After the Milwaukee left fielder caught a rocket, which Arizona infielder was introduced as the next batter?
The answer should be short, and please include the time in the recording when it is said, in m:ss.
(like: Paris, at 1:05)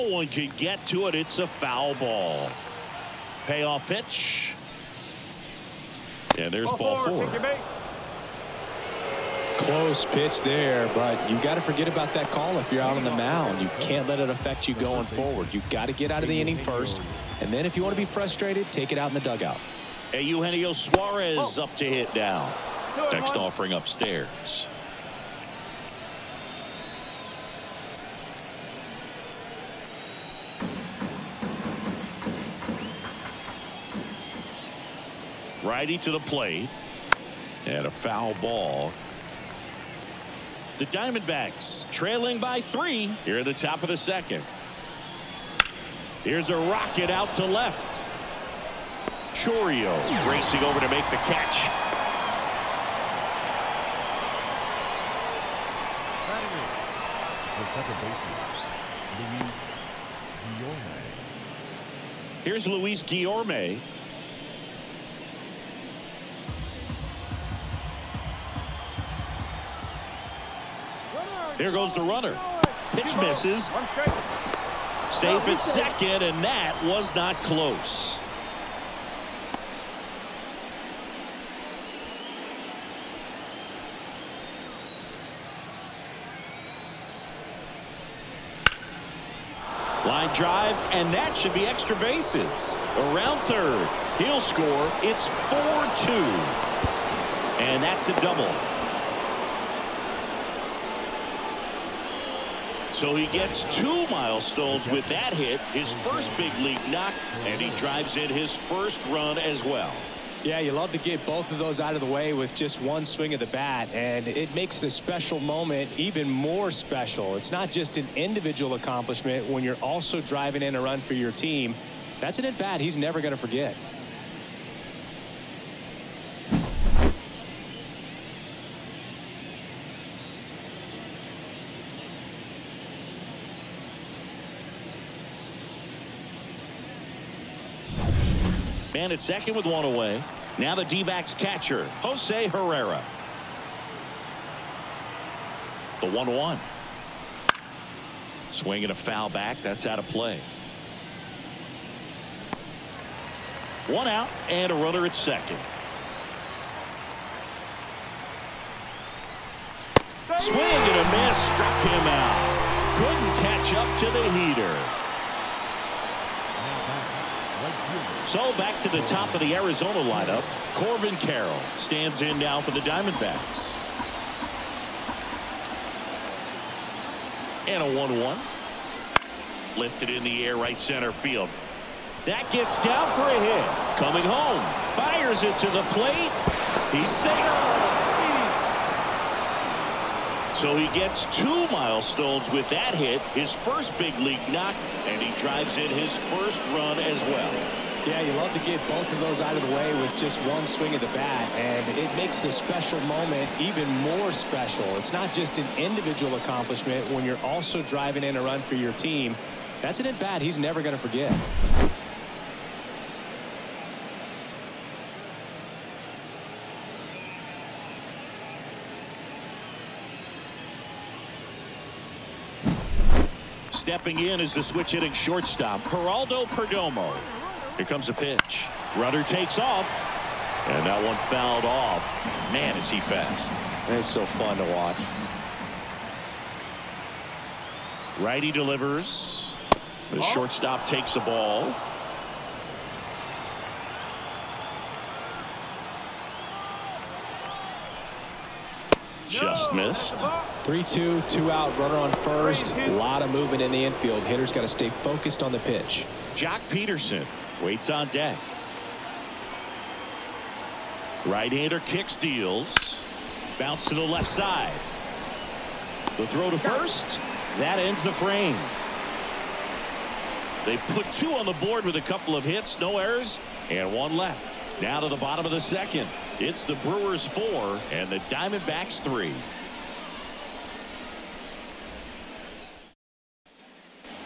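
Luis Guillorme, at 1:02.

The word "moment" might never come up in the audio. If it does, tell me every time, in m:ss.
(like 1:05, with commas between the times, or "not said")
1:55, 3:23.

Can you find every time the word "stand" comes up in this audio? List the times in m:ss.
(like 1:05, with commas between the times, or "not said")
2:18, 2:51.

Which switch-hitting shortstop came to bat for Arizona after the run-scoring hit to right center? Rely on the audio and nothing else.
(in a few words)
Geraldo Perdomo.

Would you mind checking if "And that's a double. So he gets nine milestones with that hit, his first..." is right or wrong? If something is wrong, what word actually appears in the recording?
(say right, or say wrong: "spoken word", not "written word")
wrong: "two", not "nine".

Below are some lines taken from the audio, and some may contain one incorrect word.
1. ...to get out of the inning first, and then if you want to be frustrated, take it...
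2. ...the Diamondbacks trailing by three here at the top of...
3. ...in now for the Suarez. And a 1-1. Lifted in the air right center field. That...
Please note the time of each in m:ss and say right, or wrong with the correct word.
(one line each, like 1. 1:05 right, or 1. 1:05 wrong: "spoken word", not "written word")
1. 0:15 right
2. 0:40 right
3. 2:52 wrong: "Diamondbacks", not "Suarez".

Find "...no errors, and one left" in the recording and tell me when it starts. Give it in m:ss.
4:32.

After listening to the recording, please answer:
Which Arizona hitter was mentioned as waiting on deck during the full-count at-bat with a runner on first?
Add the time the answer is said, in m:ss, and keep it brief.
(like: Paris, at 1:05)
Joc Pederson, at 4:16.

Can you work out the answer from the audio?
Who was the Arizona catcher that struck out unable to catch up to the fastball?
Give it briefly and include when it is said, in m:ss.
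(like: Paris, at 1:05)
Jose Herrera, at 2:22.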